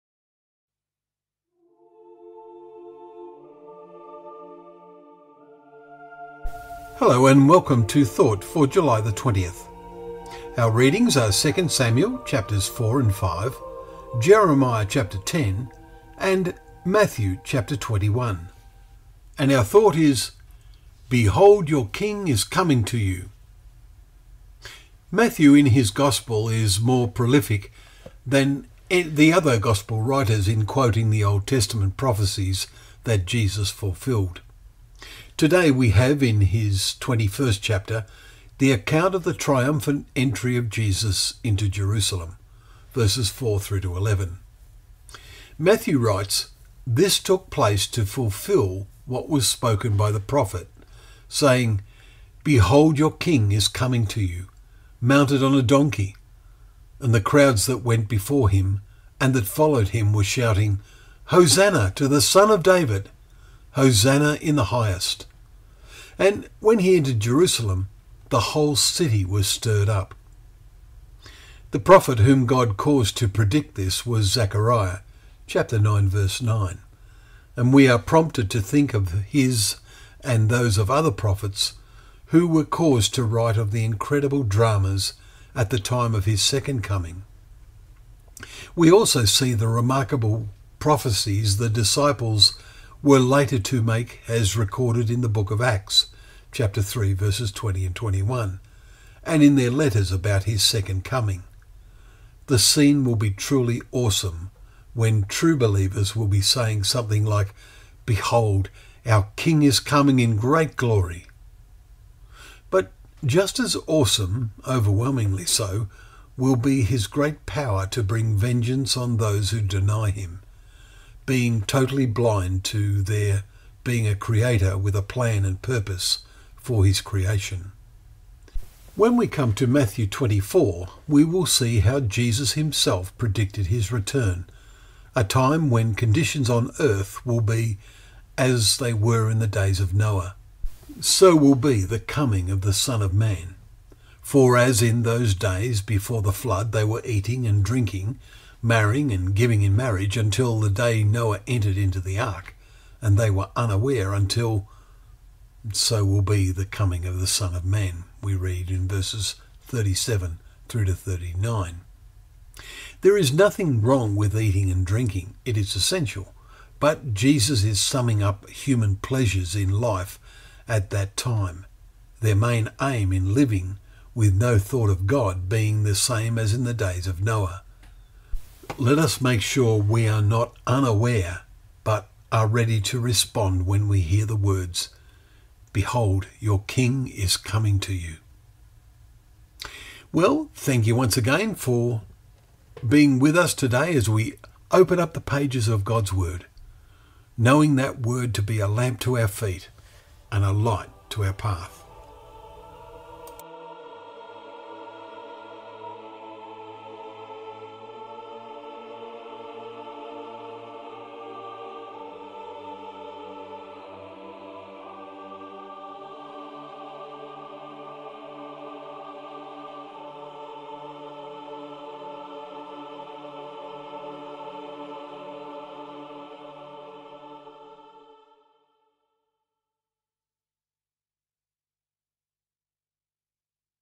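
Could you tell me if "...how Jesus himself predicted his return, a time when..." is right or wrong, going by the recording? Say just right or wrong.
right.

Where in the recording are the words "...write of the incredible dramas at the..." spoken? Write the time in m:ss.
1:23.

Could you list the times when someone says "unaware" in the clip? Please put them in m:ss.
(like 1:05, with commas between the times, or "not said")
2:33, 3:00.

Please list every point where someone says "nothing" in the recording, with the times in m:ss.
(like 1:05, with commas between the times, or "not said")
2:43.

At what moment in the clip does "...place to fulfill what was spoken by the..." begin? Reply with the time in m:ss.
0:47.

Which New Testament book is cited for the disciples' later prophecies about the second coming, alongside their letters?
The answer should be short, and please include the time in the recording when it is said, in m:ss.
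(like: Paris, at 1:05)
Acts, at 1:35.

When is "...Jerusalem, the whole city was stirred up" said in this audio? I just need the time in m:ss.
1:07.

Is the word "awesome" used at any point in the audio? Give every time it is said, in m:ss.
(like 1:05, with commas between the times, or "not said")
1:43, 1:53.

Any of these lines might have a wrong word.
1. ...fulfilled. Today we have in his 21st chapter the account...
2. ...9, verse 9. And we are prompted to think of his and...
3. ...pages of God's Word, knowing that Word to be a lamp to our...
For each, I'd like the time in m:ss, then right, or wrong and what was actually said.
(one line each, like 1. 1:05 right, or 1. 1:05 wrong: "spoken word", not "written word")
1. 0:33 right
2. 1:15 right
3. 3:15 right.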